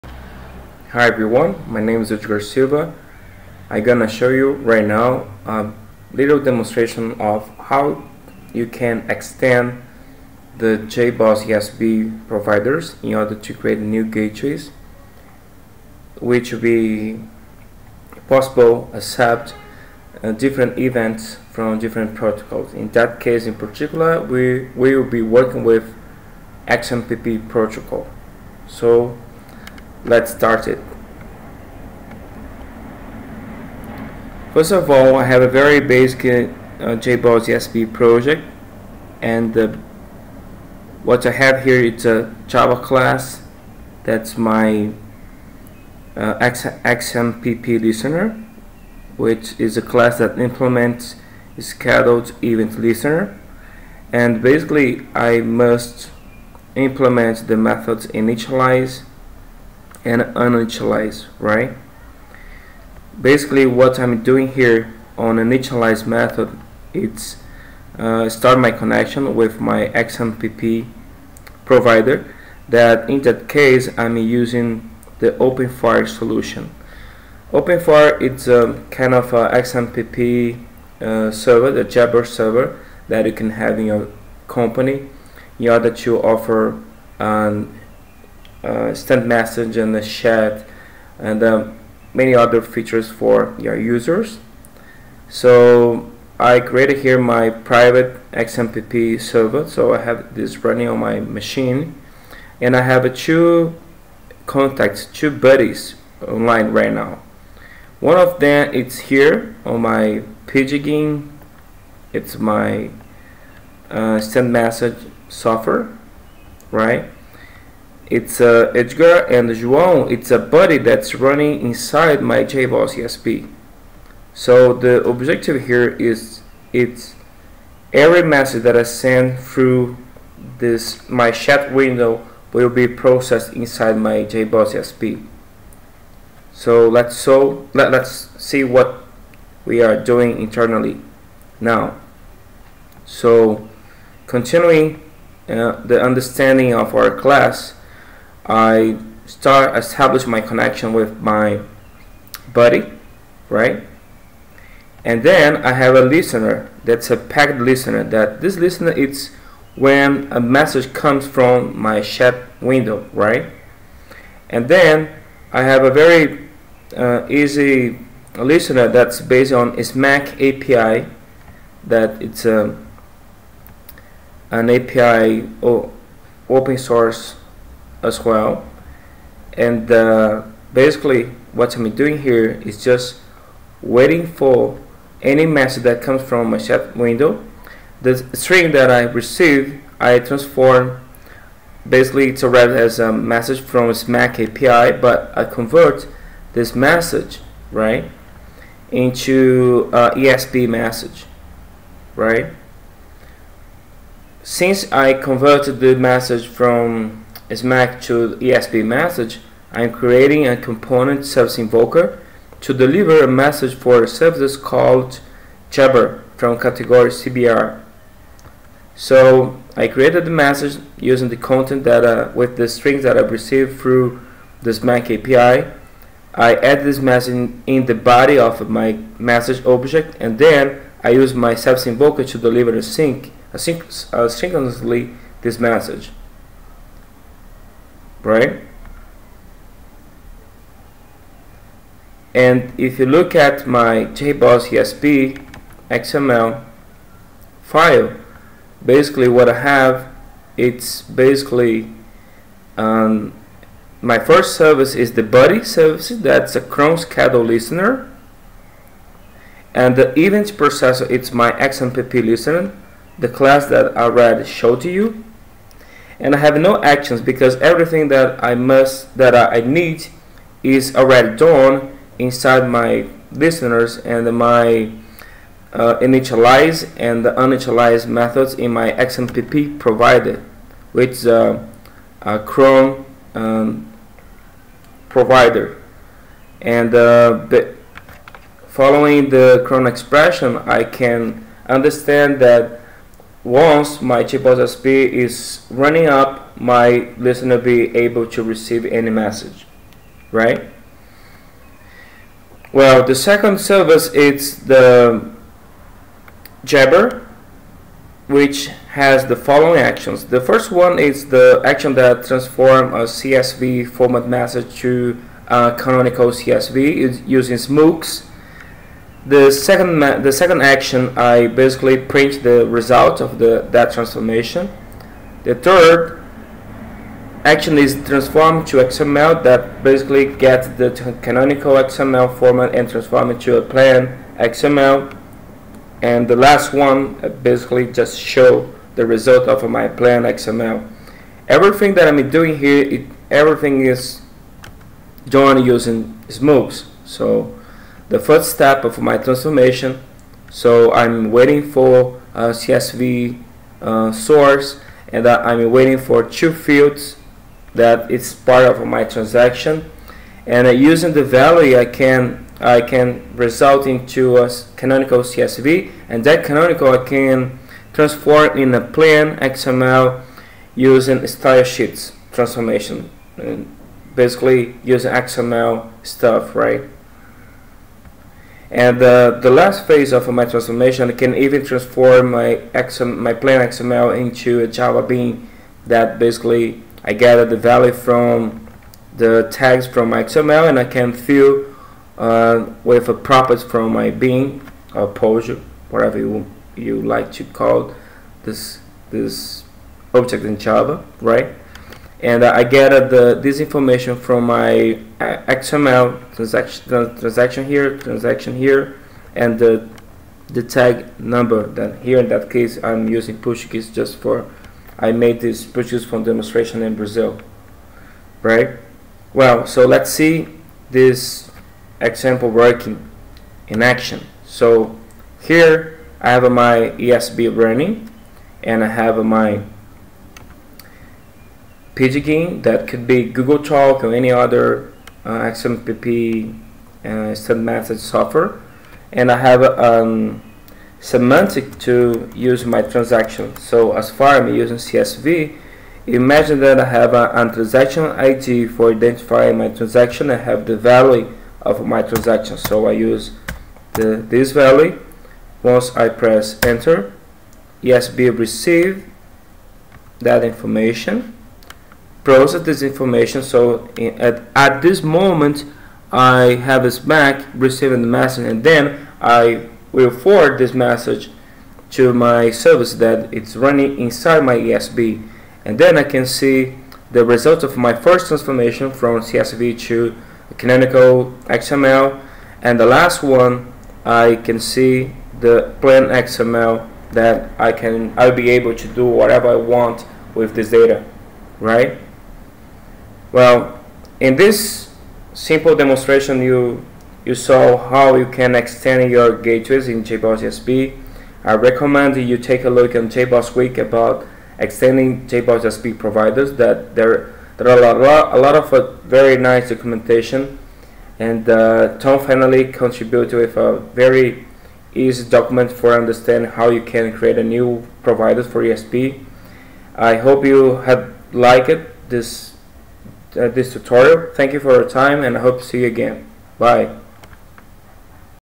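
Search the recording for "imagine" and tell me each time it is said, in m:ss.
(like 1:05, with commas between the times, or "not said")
7:26.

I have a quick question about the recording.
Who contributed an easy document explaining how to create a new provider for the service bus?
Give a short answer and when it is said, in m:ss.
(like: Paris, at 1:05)
Tom Fennelly, at 8:31.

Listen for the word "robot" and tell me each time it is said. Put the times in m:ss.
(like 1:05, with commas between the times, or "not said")
not said.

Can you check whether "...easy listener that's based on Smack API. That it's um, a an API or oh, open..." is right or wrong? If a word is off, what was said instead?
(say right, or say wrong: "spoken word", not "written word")
right.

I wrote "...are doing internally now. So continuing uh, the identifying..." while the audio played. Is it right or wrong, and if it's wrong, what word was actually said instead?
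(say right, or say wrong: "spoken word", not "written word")
wrong: "understanding", not "identifying".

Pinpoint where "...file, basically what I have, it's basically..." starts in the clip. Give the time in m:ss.
4:07.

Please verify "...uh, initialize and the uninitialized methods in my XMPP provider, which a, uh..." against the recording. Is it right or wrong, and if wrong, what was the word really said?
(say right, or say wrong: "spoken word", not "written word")
right.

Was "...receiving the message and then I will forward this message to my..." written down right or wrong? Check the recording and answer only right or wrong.
right.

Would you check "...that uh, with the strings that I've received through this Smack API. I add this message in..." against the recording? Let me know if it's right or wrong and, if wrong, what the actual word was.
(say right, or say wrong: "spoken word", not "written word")
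right.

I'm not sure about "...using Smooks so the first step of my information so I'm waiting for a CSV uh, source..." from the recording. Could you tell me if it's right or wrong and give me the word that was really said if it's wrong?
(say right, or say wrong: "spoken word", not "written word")
wrong: "transformation", not "information".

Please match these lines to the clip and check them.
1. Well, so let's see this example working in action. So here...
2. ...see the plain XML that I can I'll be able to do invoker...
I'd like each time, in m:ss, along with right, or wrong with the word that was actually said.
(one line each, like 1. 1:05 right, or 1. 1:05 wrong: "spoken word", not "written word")
1. 6:59 right
2. 8:04 wrong: "whatever", not "invoker".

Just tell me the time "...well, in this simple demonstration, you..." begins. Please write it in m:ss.
8:13.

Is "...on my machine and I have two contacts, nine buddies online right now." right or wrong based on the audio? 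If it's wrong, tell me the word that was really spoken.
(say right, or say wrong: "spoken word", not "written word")
wrong: "two", not "nine".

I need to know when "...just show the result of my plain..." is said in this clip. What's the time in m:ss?
5:37.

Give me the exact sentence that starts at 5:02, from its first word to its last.
Well, the second service is the Jabber, which has the following actions.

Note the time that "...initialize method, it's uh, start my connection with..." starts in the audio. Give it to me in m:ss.
1:05.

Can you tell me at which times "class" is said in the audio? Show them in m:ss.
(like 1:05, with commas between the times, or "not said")
0:42, 0:49, 2:27, 4:23.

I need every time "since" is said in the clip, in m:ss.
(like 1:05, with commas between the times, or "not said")
3:24.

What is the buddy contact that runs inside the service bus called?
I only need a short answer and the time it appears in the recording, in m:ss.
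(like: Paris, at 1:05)
João, at 1:59.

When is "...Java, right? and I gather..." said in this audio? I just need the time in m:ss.
6:40.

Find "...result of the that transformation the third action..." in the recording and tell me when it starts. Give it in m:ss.
5:22.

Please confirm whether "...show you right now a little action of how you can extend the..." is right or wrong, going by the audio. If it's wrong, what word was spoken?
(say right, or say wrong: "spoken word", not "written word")
wrong: "demonstration", not "action".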